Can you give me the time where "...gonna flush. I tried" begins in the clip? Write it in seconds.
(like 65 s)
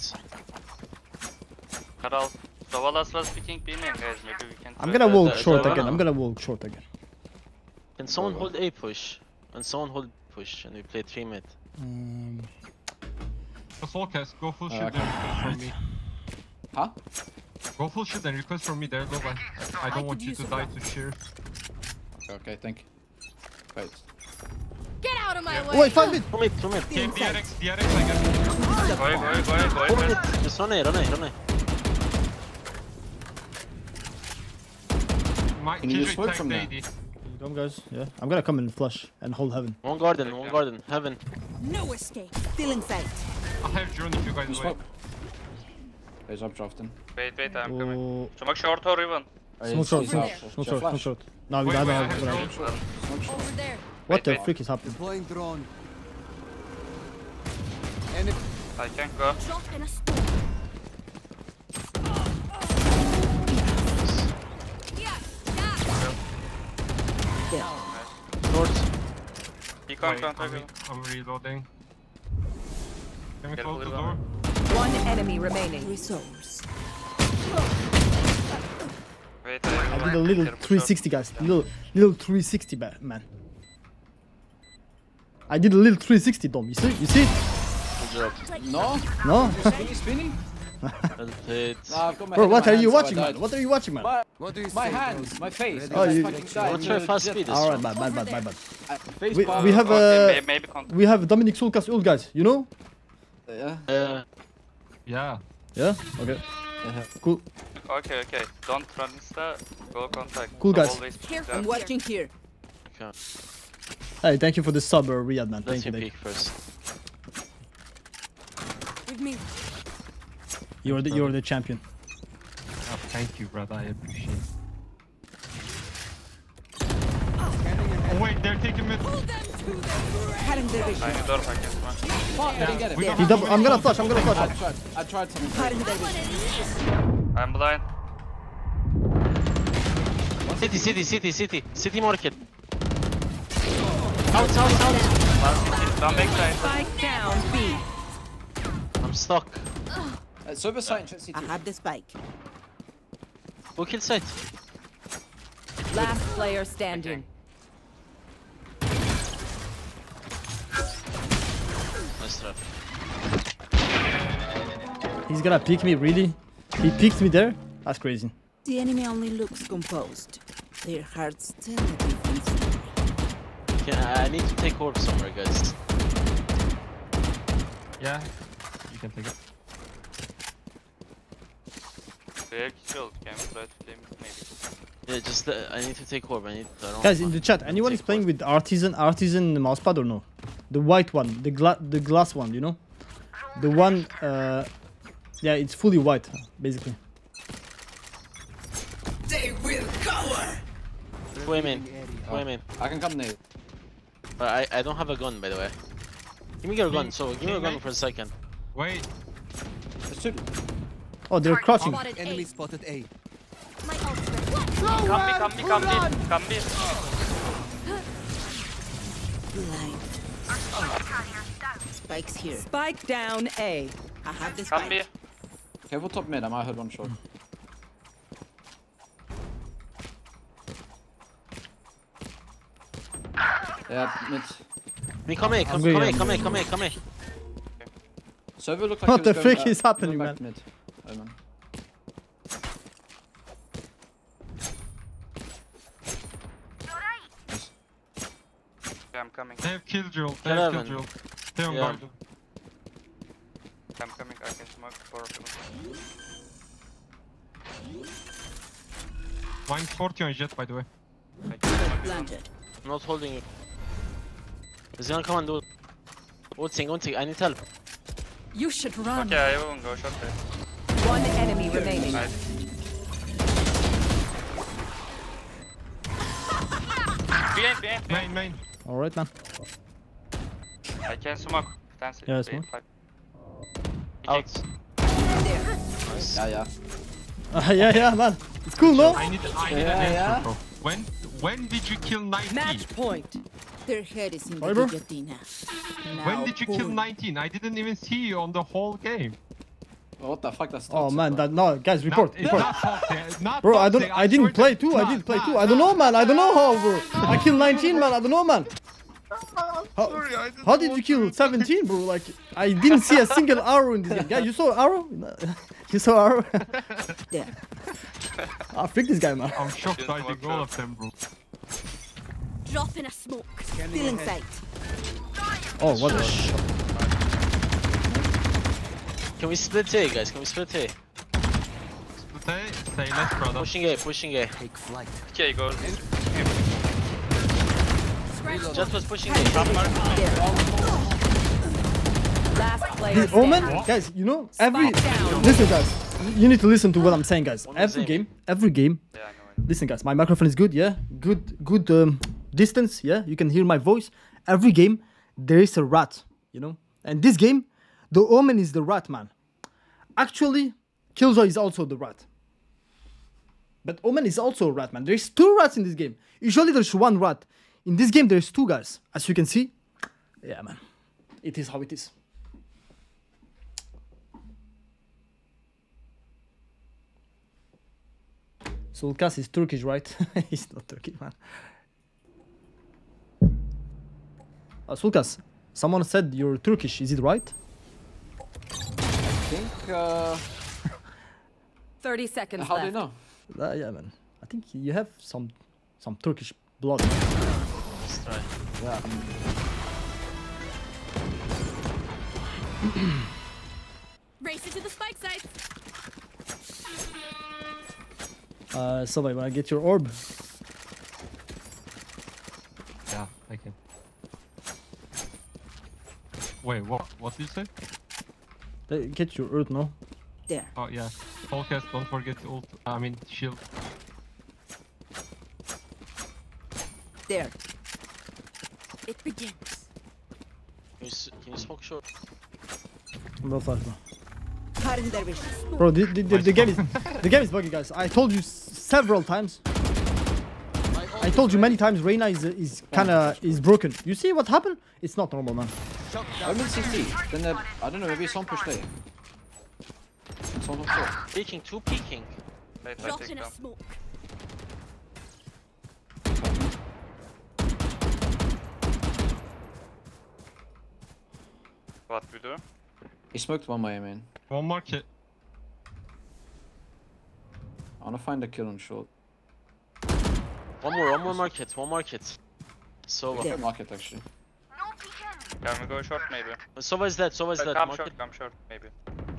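134 s.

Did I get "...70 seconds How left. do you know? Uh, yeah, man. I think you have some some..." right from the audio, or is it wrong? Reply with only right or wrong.
wrong.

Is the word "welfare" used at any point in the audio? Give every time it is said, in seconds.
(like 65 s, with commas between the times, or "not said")
not said.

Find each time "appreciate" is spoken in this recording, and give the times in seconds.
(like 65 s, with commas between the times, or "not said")
123 s.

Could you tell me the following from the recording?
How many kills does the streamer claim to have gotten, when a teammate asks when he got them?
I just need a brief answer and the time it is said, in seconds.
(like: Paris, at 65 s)
19, at 307 s.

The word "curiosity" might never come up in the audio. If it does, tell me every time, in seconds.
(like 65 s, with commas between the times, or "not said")
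not said.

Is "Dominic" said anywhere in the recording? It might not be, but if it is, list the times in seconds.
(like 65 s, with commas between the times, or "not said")
101 s.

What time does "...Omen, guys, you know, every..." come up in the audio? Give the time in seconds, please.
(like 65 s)
343 s.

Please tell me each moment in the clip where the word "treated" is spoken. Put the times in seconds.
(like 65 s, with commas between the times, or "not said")
not said.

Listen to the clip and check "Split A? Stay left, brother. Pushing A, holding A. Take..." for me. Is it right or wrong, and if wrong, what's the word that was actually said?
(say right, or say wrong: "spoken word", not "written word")
wrong: "pushing", not "holding".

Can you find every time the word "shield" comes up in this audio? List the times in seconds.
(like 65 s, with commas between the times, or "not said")
182 s, 423 s.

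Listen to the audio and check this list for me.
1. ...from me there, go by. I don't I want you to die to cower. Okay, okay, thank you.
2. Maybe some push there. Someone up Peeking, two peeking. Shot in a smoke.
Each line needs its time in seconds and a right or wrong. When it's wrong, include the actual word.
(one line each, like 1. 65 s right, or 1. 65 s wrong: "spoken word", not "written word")
1. 18 s wrong: "cheer", not "cower"
2. 448 s right.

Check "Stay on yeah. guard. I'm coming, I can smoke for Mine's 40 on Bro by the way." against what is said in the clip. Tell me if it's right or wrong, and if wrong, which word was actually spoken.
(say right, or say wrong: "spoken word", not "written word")
wrong: "Jett", not "Bro".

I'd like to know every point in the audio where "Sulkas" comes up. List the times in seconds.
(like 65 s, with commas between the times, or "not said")
101 s, 384 s.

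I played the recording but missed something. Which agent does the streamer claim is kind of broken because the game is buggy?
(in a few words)
Reyna.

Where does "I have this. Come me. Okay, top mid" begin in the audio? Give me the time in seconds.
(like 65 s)
224 s.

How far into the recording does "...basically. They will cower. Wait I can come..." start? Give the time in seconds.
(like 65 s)
196 s.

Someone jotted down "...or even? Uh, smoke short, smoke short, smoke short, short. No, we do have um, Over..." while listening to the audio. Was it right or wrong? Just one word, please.
right.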